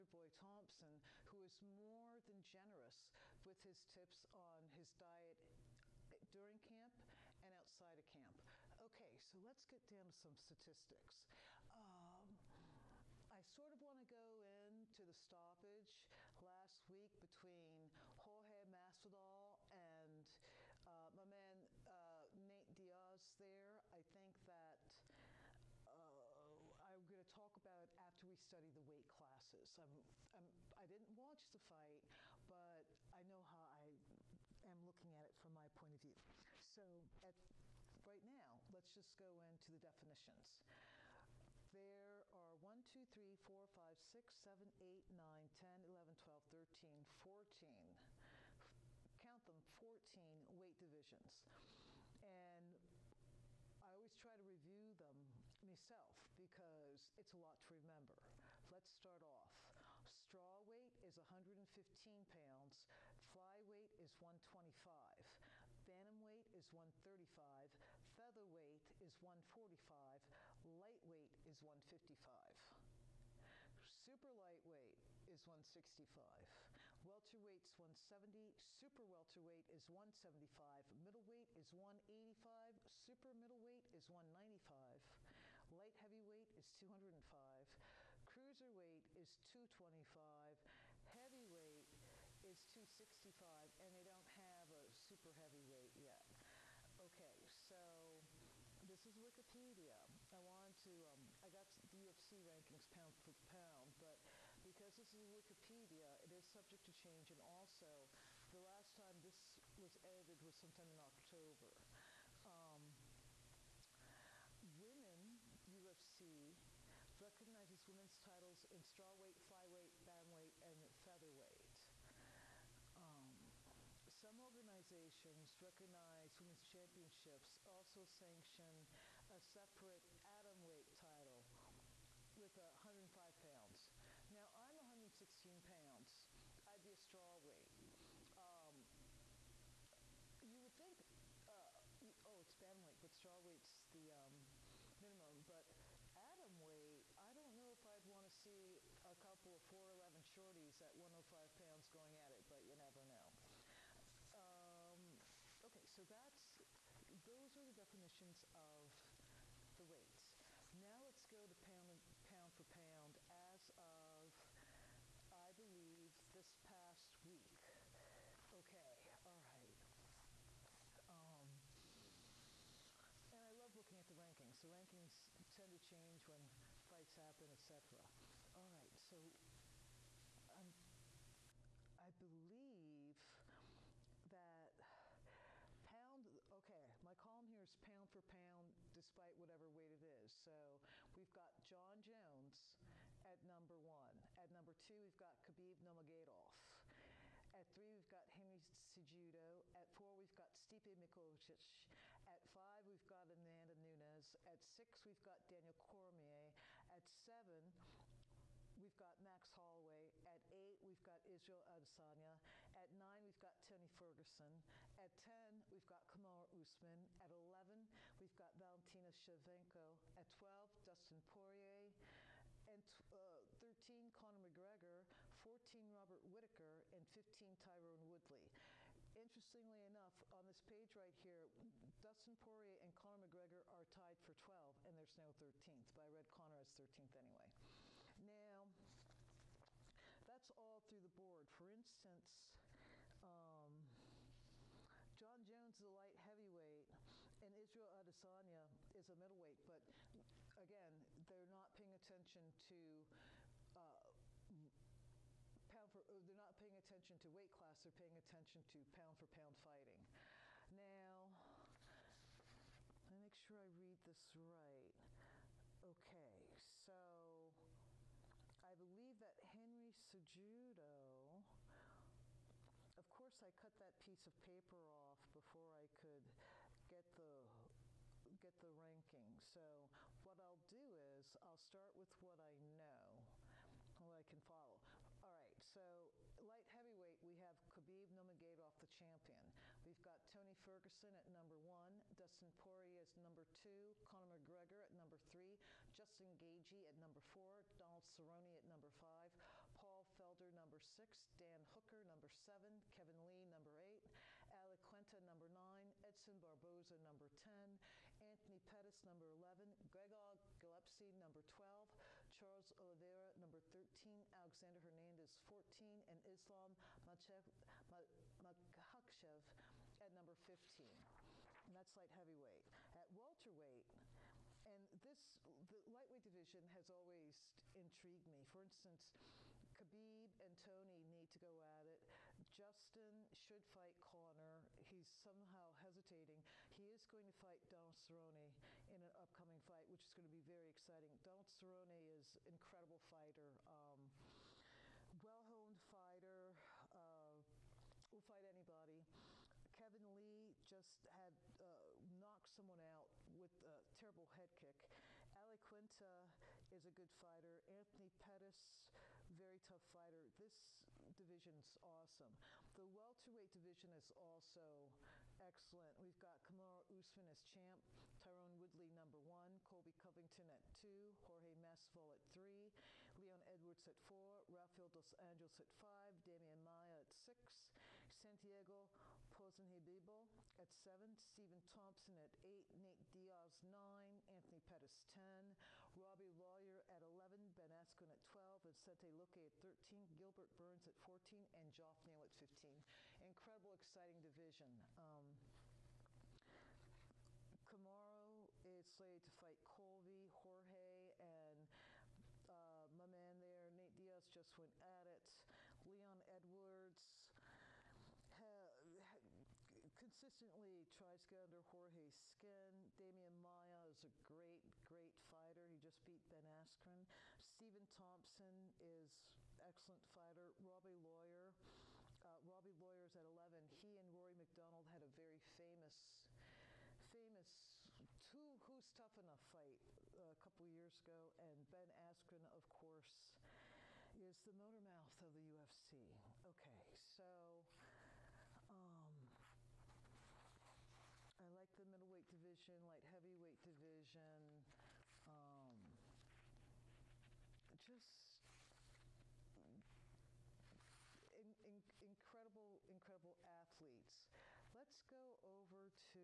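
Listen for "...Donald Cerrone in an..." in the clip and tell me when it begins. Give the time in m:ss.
5:37.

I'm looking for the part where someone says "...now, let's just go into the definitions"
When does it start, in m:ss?
0:38.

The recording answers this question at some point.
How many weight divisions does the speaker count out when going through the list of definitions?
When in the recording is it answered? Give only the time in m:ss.
0:49.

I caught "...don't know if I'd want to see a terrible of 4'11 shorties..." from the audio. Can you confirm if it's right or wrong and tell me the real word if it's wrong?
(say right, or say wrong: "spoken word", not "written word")
wrong: "couple", not "terrible".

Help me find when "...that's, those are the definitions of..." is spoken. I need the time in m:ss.
2:36.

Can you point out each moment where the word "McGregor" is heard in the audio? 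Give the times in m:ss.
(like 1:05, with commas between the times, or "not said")
3:44, 3:53, 4:54.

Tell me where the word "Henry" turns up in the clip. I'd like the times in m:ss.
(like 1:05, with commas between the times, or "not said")
3:18, 4:29.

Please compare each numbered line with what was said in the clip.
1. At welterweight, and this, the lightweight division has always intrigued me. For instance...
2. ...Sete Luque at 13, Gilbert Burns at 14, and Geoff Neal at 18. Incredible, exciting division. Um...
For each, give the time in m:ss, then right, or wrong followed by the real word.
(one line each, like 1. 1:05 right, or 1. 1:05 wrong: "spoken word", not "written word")
1. 5:22 right
2. 6:28 wrong: "15", not "18".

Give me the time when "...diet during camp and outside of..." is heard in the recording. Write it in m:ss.
0:05.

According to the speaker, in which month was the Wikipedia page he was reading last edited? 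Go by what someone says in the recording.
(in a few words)
October.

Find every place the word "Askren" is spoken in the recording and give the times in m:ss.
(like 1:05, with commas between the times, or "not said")
6:56, 7:12.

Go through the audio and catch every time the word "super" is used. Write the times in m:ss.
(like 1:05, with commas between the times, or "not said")
1:14, 1:18, 1:23, 1:35.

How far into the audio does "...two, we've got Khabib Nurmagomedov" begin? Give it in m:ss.
3:14.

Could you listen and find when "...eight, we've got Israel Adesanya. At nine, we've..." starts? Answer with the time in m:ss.
3:30.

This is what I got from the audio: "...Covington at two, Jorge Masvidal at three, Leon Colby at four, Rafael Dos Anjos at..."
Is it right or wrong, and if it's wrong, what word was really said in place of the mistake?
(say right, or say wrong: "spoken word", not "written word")
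wrong: "Edwards", not "Colby".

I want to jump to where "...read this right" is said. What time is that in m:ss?
4:23.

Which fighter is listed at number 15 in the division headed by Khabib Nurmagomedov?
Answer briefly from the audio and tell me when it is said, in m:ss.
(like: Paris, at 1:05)
Islam Makhachev, at 5:16.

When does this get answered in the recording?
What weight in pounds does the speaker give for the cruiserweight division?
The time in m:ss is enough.
1:28.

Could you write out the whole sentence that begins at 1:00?
Straw weight is 115 pounds, fly weight is 125, bantam weight is 135, feather weight is 145, lightweight is 155.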